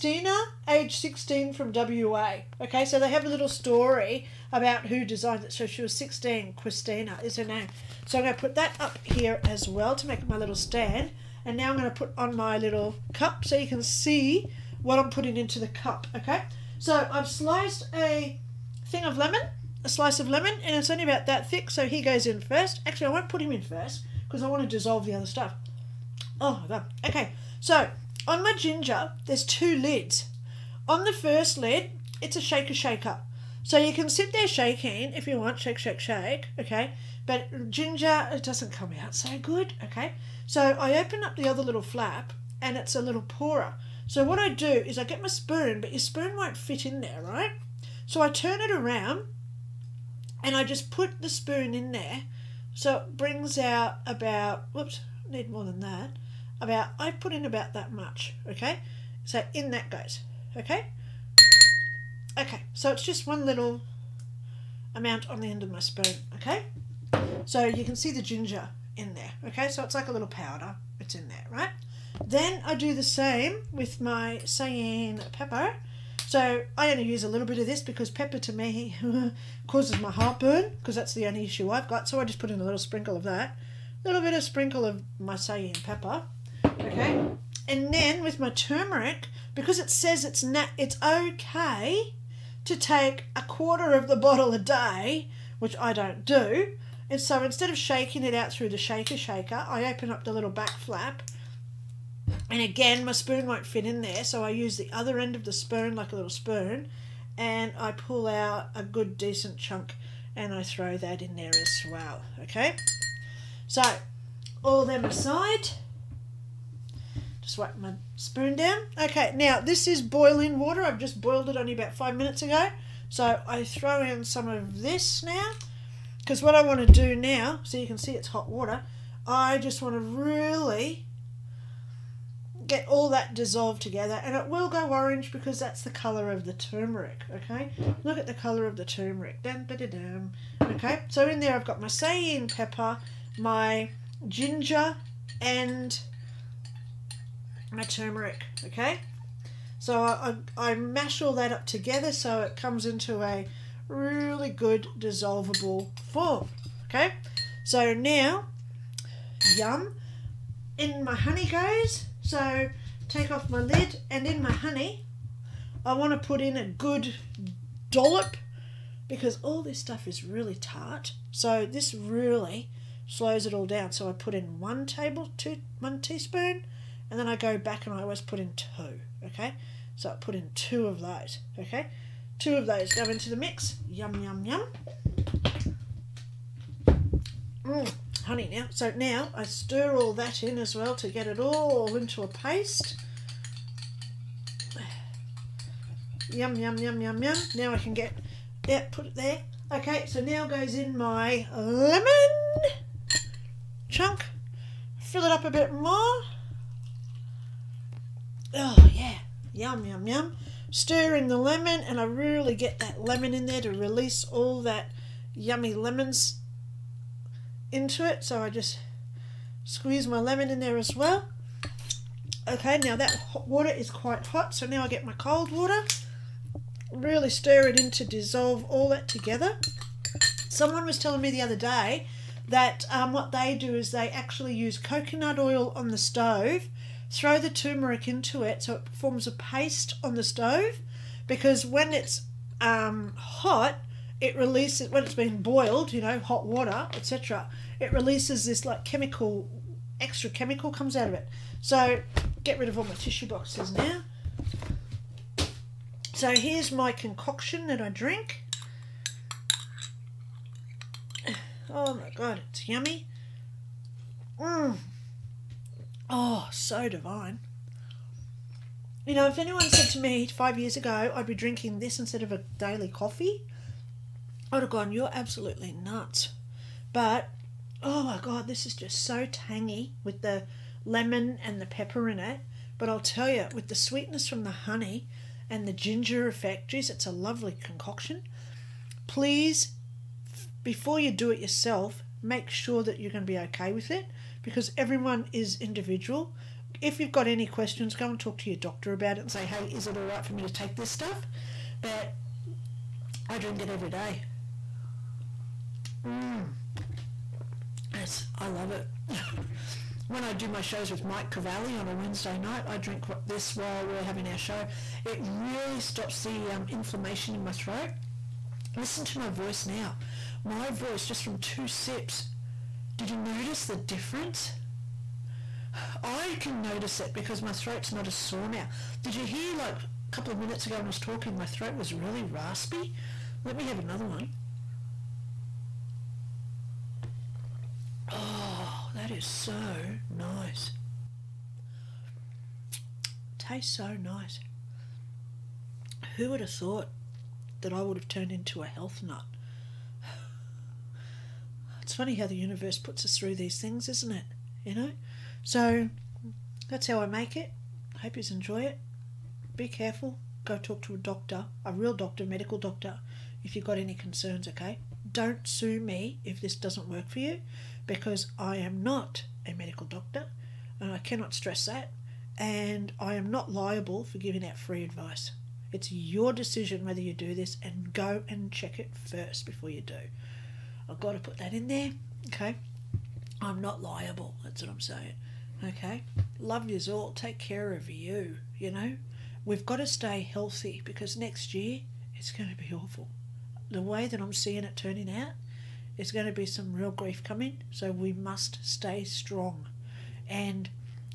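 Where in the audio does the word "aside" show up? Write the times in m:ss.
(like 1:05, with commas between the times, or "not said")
1:55.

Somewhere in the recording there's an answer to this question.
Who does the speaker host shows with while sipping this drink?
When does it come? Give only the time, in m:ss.
5:11.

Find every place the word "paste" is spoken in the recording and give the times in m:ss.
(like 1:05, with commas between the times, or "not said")
3:12, 3:59.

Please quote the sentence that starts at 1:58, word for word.
Okay, now this is boiling water.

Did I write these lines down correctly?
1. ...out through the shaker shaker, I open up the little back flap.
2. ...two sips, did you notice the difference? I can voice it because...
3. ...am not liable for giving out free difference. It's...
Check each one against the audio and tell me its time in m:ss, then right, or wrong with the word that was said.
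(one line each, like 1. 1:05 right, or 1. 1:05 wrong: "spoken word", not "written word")
1. 1:38 right
2. 5:21 wrong: "notice", not "voice"
3. 6:13 wrong: "advice", not "difference".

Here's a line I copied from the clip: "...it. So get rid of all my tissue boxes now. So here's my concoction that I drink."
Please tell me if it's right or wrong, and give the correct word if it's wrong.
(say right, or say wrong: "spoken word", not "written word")
right.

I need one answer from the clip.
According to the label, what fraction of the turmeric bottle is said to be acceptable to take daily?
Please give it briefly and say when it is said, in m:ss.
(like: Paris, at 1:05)
a quarter, at 1:33.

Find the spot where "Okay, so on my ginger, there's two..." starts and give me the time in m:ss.
0:27.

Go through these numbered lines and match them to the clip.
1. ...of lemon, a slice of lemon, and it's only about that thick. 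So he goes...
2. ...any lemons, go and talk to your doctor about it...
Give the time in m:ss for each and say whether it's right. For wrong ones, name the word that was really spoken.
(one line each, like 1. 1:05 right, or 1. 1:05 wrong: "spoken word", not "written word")
1. 0:19 right
2. 4:57 wrong: "questions", not "lemons".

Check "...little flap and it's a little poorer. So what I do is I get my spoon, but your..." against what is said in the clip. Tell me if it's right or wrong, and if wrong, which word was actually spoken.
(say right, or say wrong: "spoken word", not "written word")
right.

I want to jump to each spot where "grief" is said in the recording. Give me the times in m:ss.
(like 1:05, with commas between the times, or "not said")
6:36.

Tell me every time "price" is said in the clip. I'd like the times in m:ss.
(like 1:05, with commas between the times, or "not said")
not said.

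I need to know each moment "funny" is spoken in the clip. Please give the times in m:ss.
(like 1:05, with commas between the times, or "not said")
5:51.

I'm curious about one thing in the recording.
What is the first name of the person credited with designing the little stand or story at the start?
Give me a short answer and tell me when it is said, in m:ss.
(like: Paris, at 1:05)
Christina, at 0:06.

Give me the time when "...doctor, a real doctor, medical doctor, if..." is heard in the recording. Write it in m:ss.
6:00.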